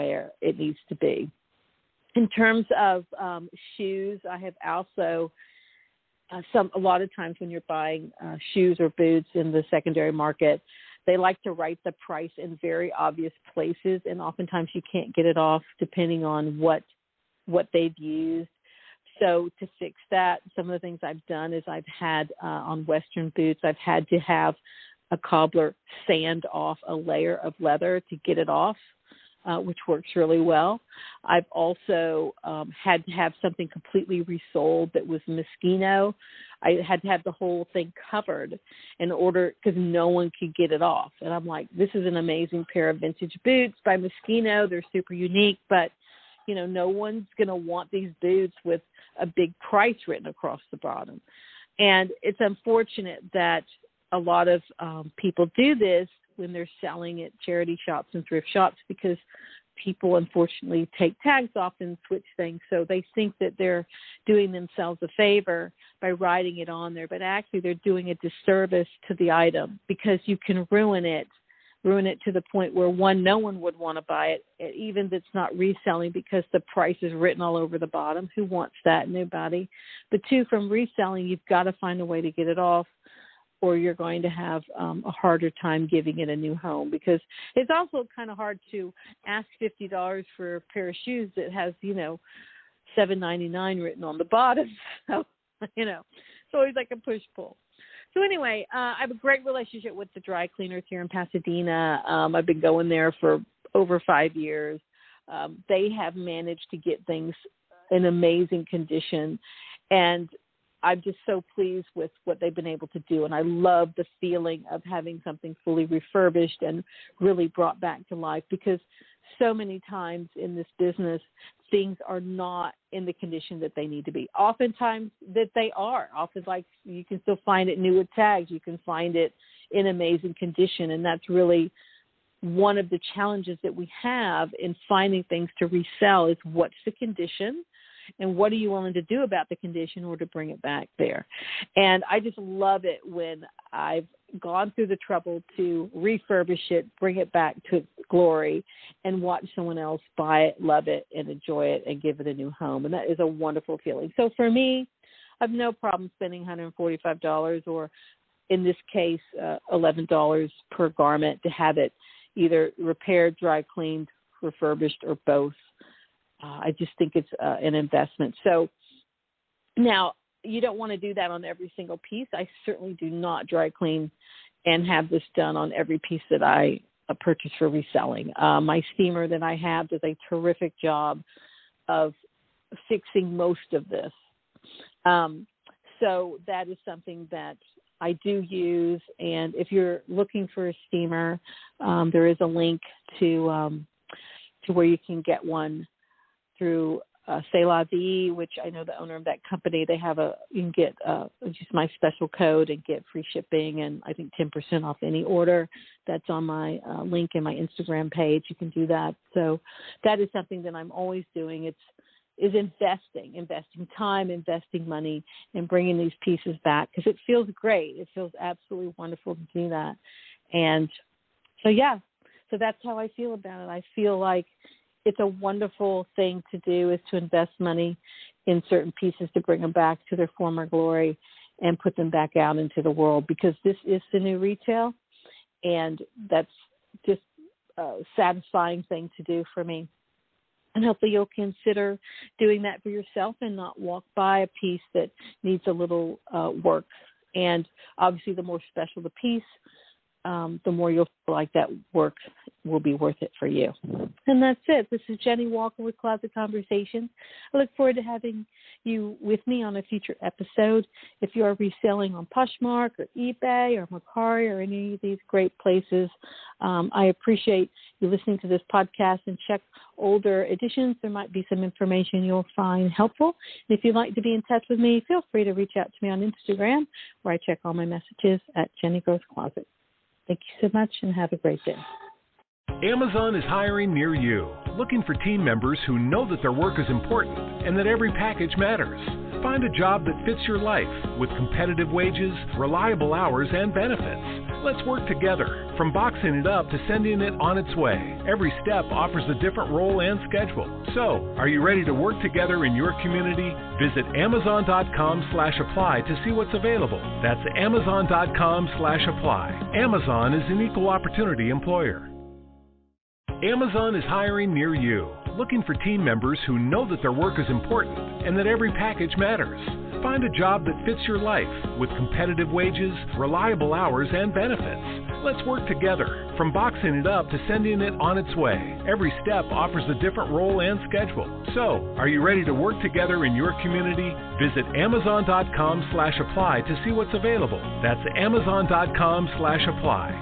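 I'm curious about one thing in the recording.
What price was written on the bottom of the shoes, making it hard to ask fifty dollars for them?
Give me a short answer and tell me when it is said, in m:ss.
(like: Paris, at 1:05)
$7.99, at 1:32.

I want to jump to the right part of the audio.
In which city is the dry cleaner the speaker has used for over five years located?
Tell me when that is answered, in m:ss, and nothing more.
1:41.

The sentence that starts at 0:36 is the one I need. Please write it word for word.
I had to have the whole thing covered in order because no one could get it off.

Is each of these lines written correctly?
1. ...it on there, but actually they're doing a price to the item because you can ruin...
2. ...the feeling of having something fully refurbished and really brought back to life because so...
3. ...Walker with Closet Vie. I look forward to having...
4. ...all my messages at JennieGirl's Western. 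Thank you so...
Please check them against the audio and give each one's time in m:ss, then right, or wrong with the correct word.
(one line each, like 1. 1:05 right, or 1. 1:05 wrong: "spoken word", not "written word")
1. 1:06 wrong: "disservice", not "price"
2. 1:53 right
3. 4:15 wrong: "Conversations", not "Vie"
4. 4:37 wrong: "Closet", not "Western".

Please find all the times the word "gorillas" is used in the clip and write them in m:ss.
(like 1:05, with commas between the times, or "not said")
not said.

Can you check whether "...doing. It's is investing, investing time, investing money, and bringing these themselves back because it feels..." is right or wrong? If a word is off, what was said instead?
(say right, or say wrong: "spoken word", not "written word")
wrong: "pieces", not "themselves".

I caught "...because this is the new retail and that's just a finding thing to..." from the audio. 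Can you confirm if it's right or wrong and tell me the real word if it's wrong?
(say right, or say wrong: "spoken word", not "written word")
wrong: "satisfying", not "finding".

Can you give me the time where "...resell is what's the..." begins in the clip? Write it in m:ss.
2:15.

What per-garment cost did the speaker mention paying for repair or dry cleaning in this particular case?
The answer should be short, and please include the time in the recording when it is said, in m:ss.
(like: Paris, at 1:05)
$11, at 2:39.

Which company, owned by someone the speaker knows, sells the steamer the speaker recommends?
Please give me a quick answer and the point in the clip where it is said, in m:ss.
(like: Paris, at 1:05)
C'est La Vie, at 3:17.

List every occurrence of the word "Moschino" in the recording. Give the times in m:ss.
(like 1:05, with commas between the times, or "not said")
0:35, 0:43.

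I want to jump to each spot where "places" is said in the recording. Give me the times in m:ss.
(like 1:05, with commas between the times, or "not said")
0:13, 4:25.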